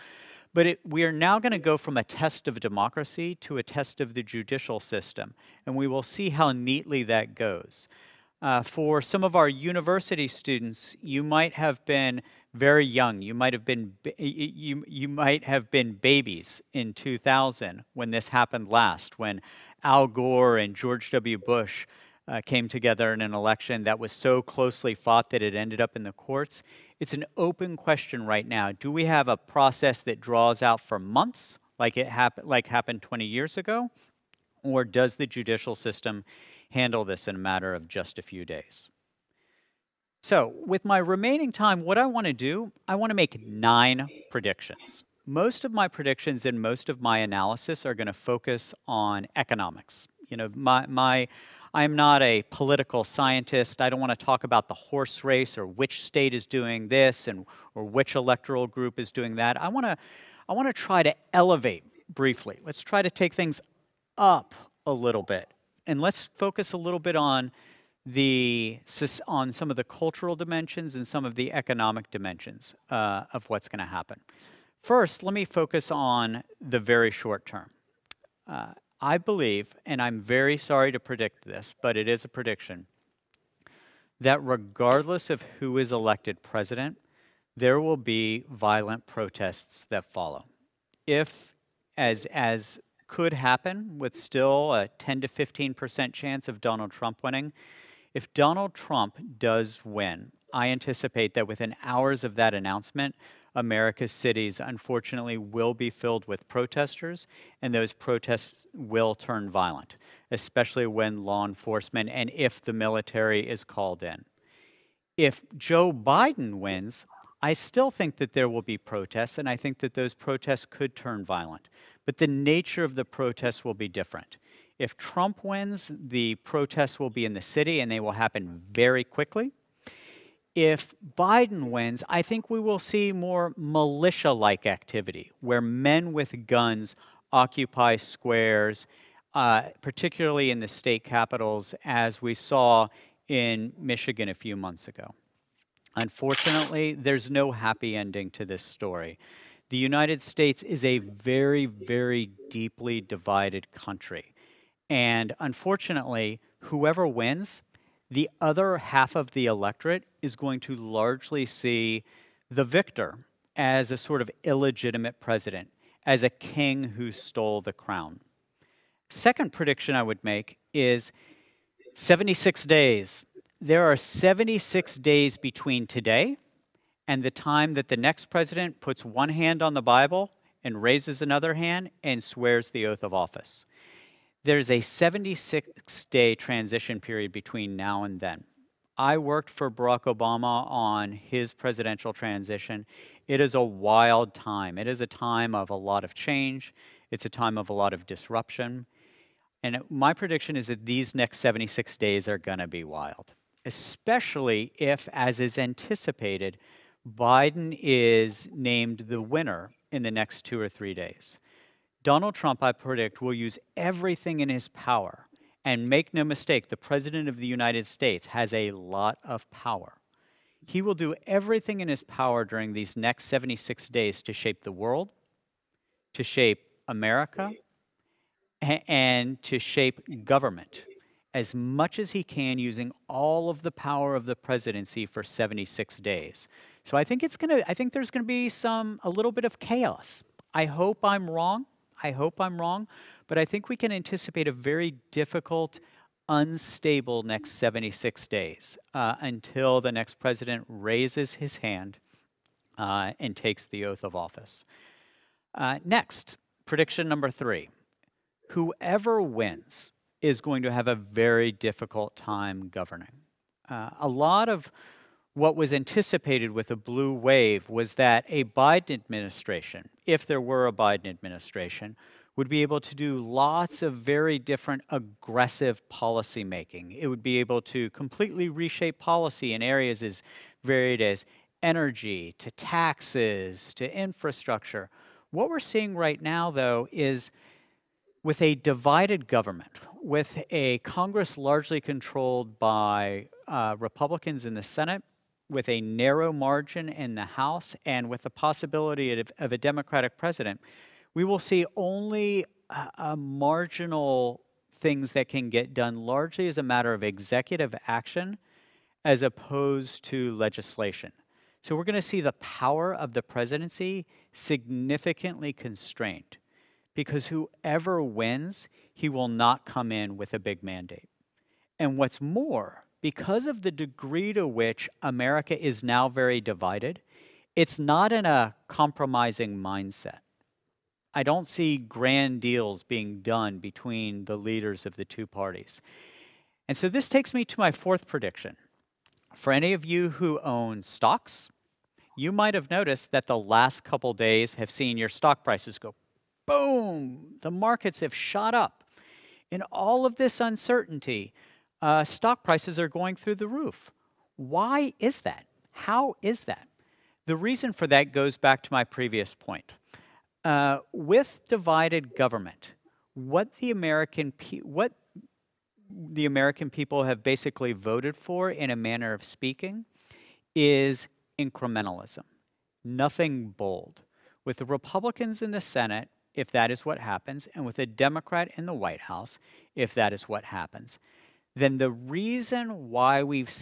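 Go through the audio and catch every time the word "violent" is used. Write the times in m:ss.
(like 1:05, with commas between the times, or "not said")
1:28, 1:49, 2:01.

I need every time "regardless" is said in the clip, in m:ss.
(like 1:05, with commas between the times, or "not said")
1:24.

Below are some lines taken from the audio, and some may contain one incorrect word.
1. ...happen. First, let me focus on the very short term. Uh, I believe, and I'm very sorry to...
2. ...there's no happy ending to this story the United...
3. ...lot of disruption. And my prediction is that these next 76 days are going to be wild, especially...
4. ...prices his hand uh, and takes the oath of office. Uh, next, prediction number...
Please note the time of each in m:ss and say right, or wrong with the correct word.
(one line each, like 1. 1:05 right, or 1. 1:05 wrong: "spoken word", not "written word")
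1. 1:13 right
2. 2:26 right
3. 3:17 right
4. 4:10 wrong: "raises", not "prices".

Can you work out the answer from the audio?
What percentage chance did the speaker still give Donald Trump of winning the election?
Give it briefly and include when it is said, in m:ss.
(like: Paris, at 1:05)
10 to 15%, at 1:34.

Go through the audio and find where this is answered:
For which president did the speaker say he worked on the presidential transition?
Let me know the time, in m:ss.
3:09.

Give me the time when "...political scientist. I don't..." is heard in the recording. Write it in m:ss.
0:52.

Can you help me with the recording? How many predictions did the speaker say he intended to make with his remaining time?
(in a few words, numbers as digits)
9.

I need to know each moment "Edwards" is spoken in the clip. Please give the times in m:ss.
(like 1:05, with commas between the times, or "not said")
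not said.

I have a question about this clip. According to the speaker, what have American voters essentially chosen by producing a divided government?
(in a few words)
Incrementalism.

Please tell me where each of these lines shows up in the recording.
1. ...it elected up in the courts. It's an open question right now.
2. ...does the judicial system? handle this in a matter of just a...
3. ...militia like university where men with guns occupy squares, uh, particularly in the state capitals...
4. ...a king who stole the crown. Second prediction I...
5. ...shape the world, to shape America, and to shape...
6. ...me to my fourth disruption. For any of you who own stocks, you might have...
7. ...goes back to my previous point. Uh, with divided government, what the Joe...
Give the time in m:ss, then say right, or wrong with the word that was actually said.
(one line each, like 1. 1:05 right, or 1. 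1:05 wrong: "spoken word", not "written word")
1. 0:25 wrong: "ended", not "elected"
2. 0:34 right
3. 2:13 wrong: "activity", not "university"
4. 2:46 right
5. 3:44 right
6. 5:37 wrong: "prediction", not "disruption"
7. 5:58 wrong: "American", not "Joe".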